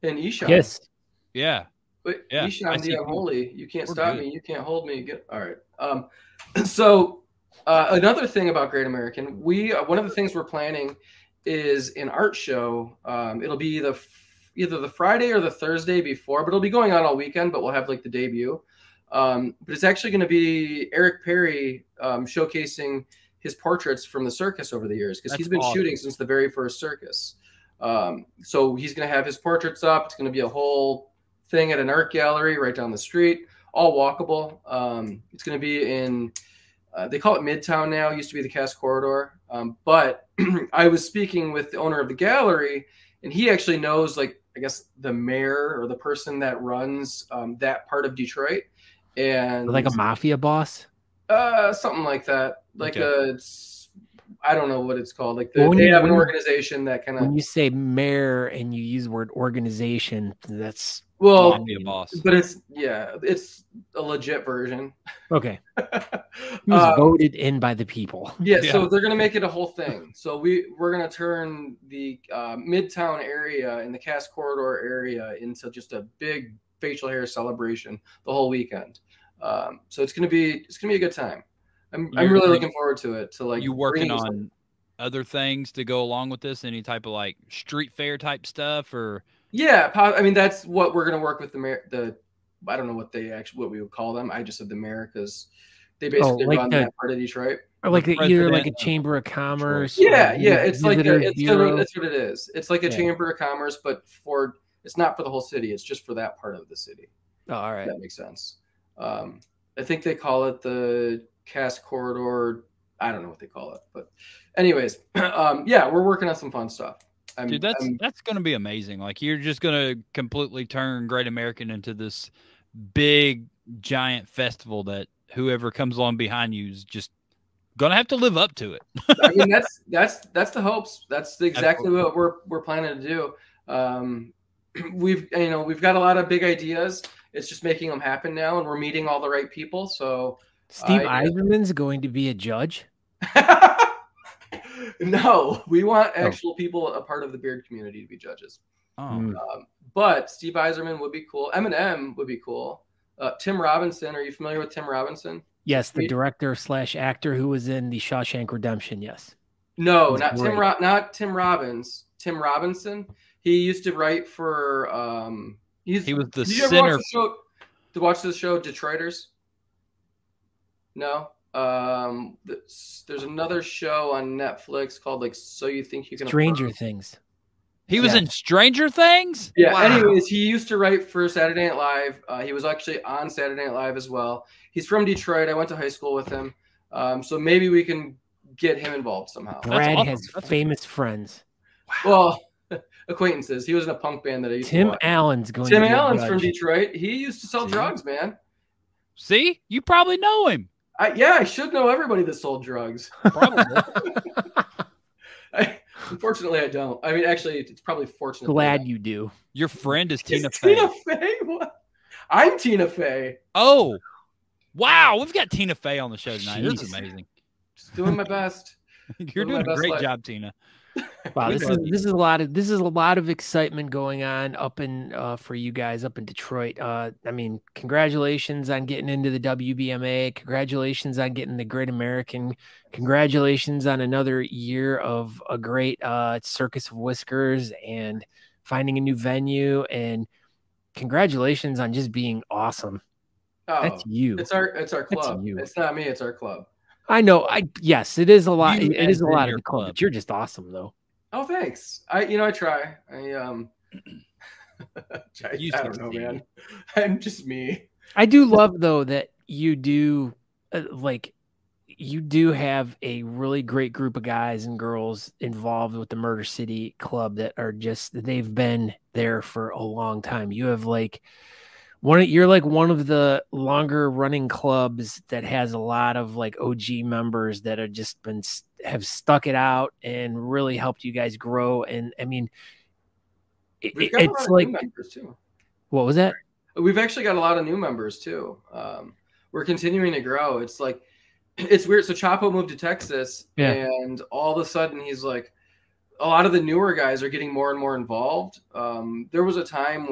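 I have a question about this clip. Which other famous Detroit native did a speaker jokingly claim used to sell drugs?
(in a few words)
Tim Allen.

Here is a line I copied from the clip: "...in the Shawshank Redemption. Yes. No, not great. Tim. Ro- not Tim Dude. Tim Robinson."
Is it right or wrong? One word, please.
wrong.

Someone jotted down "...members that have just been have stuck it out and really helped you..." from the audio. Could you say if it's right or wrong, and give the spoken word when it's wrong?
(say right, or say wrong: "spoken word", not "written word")
right.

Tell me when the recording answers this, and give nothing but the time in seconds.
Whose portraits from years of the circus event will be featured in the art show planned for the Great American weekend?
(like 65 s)
20 s.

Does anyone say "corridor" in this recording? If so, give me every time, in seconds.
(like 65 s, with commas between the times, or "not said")
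38 s, 74 s, 111 s.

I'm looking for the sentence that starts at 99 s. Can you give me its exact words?
Yeah, yeah, it's like a, it's that's what it is.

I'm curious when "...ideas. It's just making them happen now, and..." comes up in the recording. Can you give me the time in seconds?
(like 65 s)
136 s.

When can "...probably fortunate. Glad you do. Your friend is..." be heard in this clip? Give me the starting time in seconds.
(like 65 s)
207 s.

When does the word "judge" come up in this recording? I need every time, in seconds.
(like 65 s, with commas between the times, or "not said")
142 s, 148 s.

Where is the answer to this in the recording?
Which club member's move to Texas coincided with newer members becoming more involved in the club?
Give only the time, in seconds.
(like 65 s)
292 s.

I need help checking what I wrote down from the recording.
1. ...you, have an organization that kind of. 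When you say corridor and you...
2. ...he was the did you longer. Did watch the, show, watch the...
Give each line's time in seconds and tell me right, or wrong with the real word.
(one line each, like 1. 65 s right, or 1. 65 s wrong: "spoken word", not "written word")
1. 55 s wrong: "mayor", not "corridor"
2. 165 s wrong: "sinner", not "longer".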